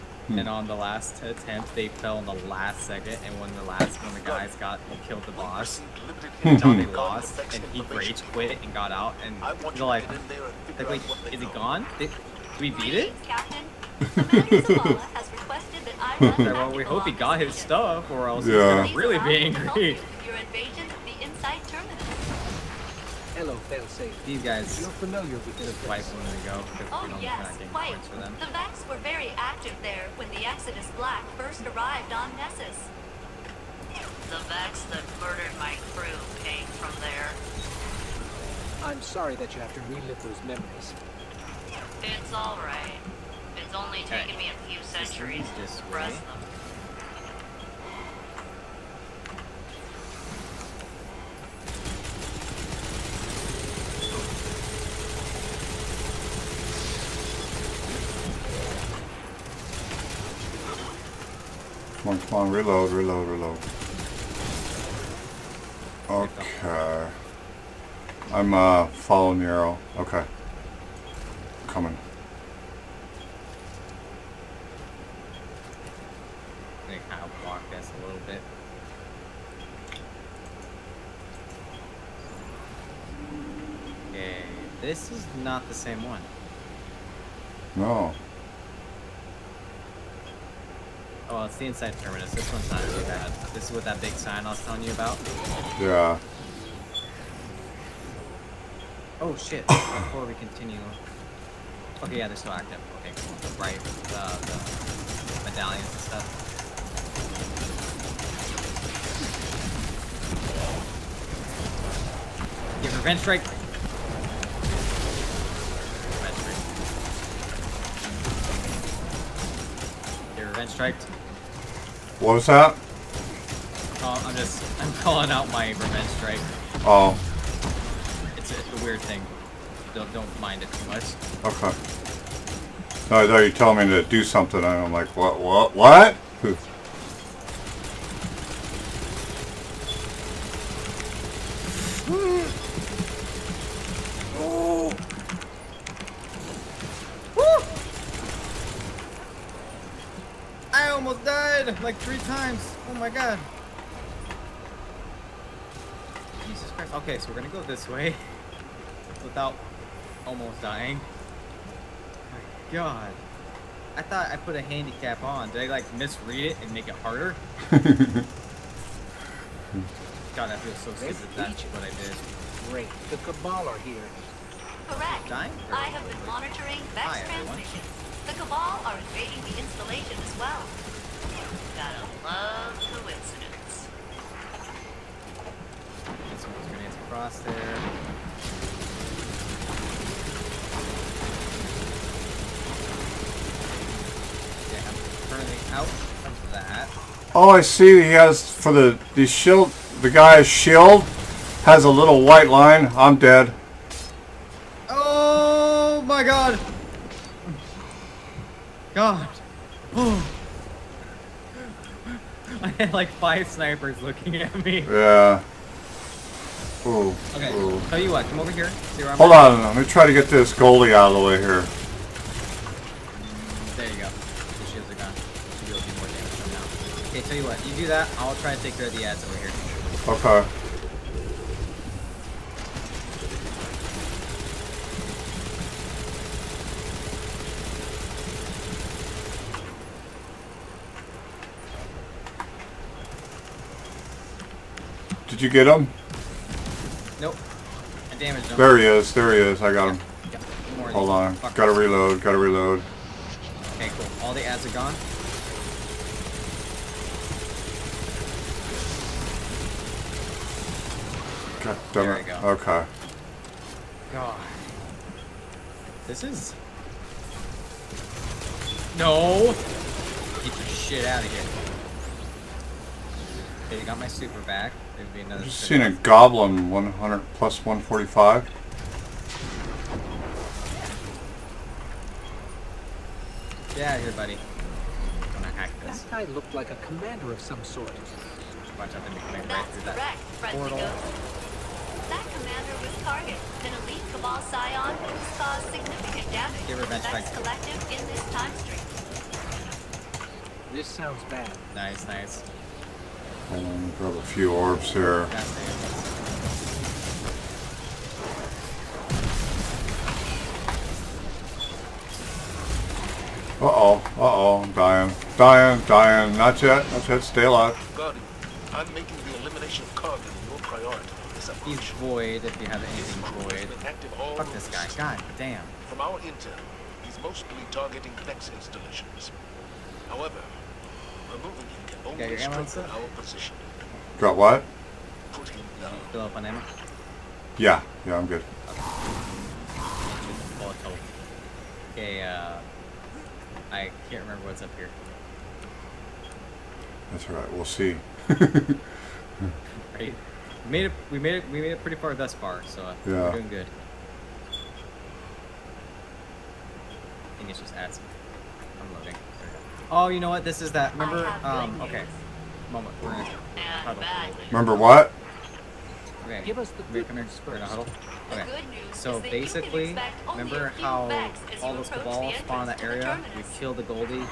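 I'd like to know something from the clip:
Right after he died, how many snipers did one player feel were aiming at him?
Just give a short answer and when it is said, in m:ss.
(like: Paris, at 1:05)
5, at 3:33.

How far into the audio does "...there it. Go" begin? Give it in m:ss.
4:22.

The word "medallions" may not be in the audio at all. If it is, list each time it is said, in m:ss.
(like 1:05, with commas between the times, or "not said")
1:45.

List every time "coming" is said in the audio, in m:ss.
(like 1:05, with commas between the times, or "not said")
1:11, 4:49.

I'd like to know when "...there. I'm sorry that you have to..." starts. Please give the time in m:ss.
0:37.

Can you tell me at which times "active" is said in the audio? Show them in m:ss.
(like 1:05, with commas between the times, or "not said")
0:29, 1:42.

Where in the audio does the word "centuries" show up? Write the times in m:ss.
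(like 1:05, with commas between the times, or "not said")
0:44.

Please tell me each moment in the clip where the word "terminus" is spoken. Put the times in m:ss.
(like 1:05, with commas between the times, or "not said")
1:32.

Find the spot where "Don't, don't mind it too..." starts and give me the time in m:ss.
2:09.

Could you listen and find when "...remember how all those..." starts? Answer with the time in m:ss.
6:10.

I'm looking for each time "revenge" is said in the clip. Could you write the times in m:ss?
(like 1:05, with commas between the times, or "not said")
1:52, 2:00, 2:05.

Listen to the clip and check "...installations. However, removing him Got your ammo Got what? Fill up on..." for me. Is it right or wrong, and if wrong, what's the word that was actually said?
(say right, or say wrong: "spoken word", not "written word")
right.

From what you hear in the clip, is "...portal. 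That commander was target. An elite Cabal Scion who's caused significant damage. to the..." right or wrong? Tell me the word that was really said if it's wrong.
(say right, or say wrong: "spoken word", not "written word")
right.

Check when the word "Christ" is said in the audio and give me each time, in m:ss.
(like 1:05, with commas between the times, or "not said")
2:36.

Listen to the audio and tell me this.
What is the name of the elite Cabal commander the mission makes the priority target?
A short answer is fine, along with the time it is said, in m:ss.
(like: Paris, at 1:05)
Cog, at 5:19.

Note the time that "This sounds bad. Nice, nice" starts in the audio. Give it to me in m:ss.
5:00.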